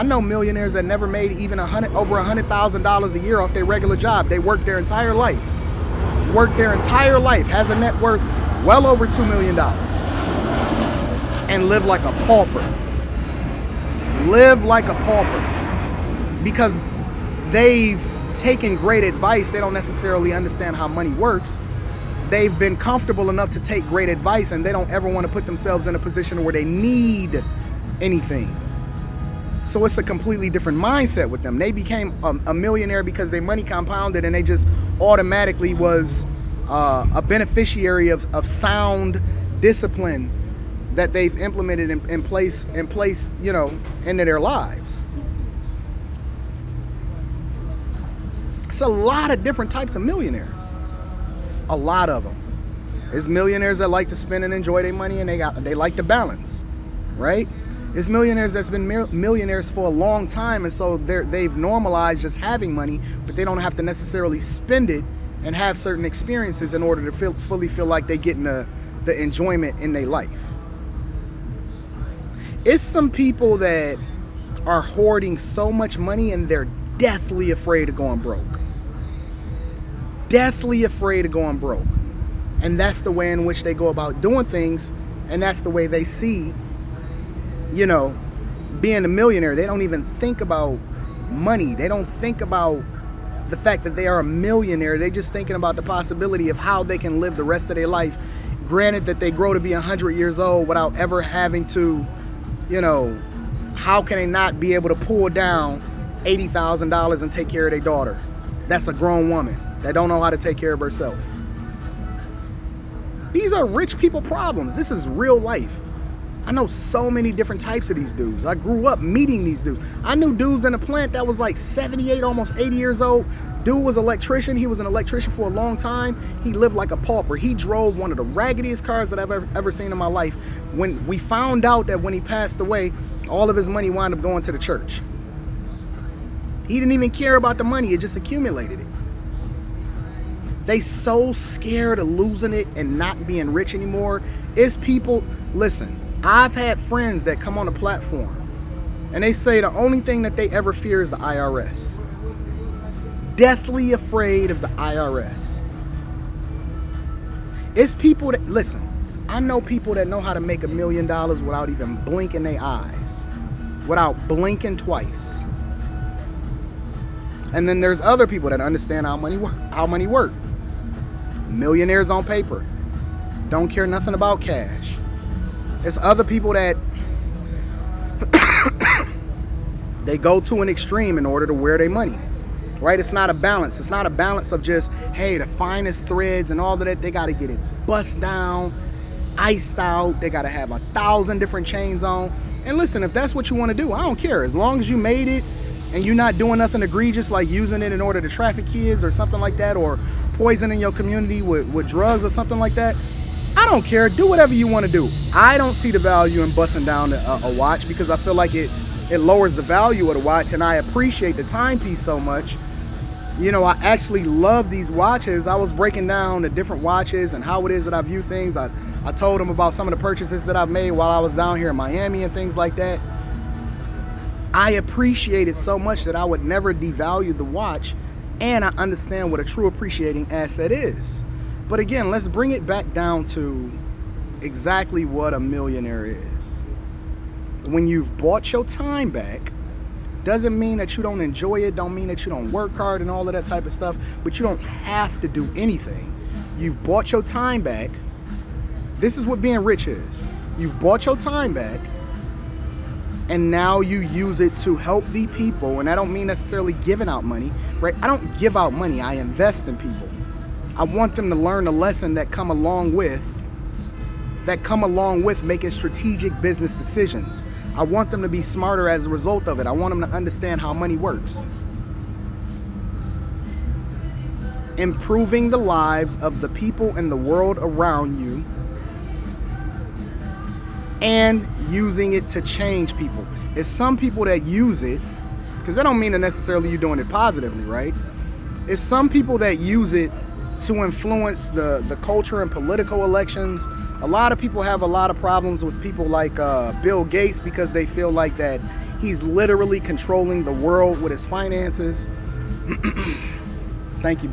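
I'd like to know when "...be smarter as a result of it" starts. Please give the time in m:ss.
4:28.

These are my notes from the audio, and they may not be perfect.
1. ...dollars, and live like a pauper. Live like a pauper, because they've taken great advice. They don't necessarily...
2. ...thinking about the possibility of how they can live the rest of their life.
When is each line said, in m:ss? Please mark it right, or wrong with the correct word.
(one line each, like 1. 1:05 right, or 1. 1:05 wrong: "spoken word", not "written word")
1. 0:09 right
2. 1:35 right.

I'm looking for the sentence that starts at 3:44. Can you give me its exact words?
I appreciate it so much that I would never devalue the watch, and I understand what a true appreciating asset is.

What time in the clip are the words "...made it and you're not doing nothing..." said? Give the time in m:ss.
3:14.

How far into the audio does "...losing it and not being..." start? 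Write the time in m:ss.
2:22.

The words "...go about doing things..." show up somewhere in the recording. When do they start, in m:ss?
1:23.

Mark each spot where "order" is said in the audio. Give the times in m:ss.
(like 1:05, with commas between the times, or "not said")
1:06, 3:01, 3:18.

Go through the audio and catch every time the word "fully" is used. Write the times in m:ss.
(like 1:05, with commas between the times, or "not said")
1:07.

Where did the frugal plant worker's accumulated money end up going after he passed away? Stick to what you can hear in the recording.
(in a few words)
The church.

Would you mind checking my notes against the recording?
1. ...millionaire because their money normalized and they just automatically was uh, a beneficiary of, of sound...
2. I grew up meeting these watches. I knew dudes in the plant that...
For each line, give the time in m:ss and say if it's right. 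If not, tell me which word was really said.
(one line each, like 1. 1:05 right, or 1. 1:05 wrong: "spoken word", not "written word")
1. 0:32 wrong: "compounded", not "normalized"
2. 1:58 wrong: "dudes", not "watches".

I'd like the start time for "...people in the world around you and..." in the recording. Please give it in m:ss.
4:36.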